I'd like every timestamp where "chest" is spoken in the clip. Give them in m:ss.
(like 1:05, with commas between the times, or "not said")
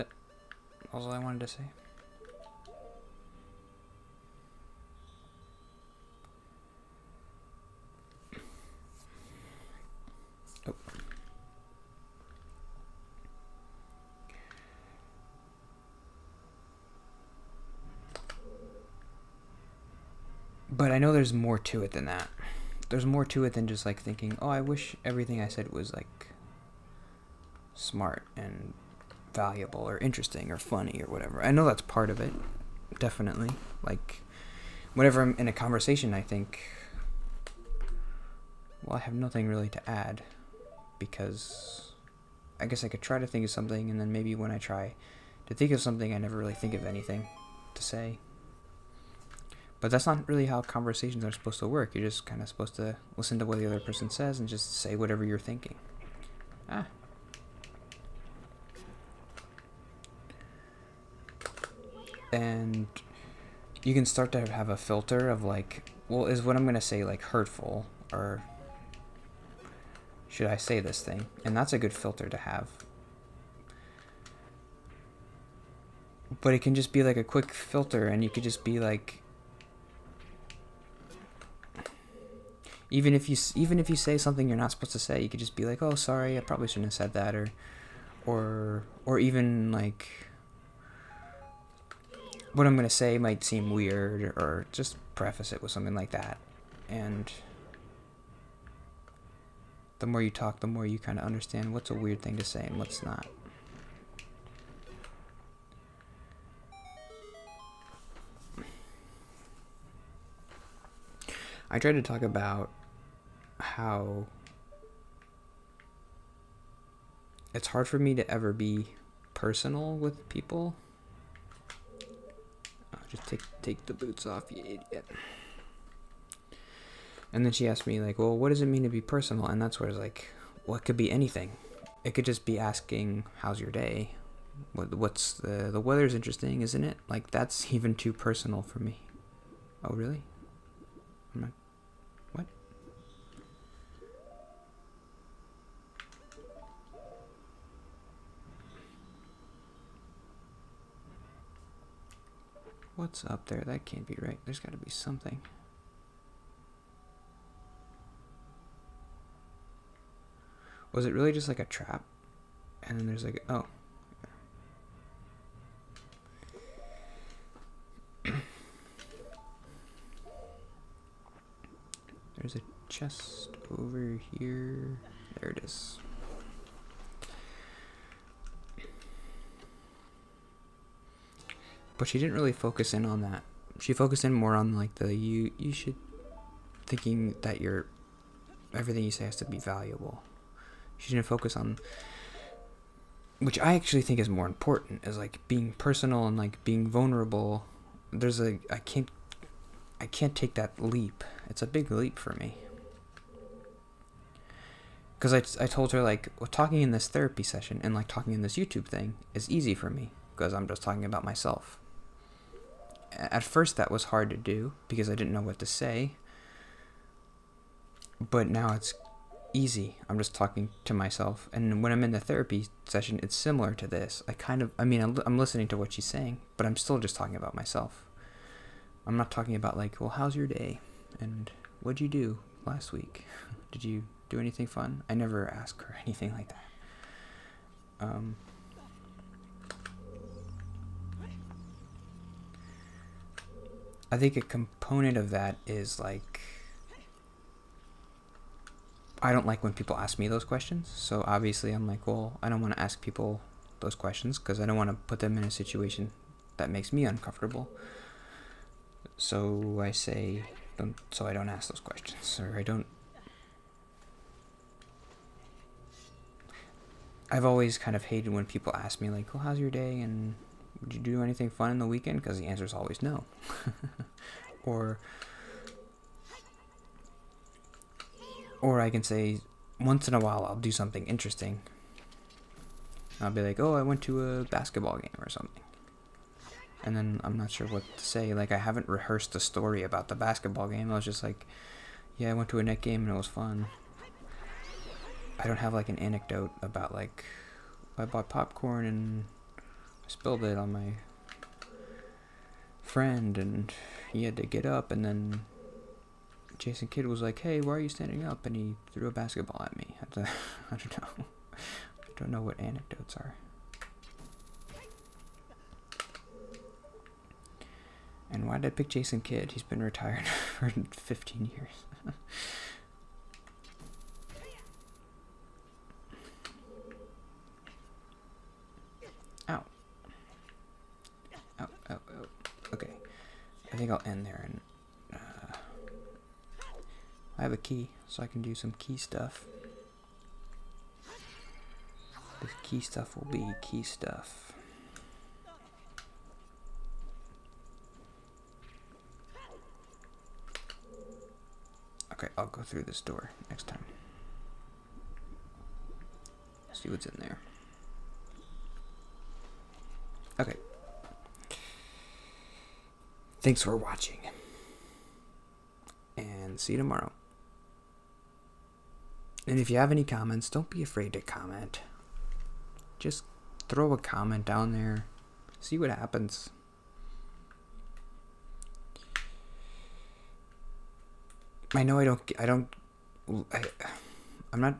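2:52.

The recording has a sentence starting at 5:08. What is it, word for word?
And he threw a basketball at me.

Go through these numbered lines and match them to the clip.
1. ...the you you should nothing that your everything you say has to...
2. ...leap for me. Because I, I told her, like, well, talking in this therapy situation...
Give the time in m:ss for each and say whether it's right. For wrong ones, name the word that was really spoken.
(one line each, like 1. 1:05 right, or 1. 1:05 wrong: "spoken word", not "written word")
1. 3:04 wrong: "thinking", not "nothing"
2. 3:21 wrong: "session", not "situation".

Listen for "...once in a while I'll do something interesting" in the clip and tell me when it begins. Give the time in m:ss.
4:39.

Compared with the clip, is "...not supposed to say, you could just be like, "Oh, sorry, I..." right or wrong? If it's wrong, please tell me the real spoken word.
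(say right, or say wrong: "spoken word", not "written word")
right.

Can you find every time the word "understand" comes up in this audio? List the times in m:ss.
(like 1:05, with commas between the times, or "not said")
1:41.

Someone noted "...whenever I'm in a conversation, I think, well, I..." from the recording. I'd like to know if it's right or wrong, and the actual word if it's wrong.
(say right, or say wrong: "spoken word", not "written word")
right.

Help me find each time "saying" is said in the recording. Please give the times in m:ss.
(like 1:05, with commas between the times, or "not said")
3:46.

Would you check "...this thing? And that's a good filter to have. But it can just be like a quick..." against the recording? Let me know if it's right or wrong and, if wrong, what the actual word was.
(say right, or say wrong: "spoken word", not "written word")
right.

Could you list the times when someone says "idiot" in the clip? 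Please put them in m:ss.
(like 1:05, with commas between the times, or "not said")
2:04.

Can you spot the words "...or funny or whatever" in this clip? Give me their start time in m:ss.
0:30.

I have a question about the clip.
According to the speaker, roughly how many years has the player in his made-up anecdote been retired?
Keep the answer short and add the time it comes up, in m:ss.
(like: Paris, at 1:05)
15, at 5:20.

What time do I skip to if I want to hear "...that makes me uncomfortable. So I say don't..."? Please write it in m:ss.
4:16.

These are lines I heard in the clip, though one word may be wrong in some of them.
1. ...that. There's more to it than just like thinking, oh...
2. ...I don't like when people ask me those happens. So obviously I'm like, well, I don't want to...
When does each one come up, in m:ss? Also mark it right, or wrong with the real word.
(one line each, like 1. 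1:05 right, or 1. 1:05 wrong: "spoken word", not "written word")
1. 0:22 right
2. 4:09 wrong: "questions", not "happens".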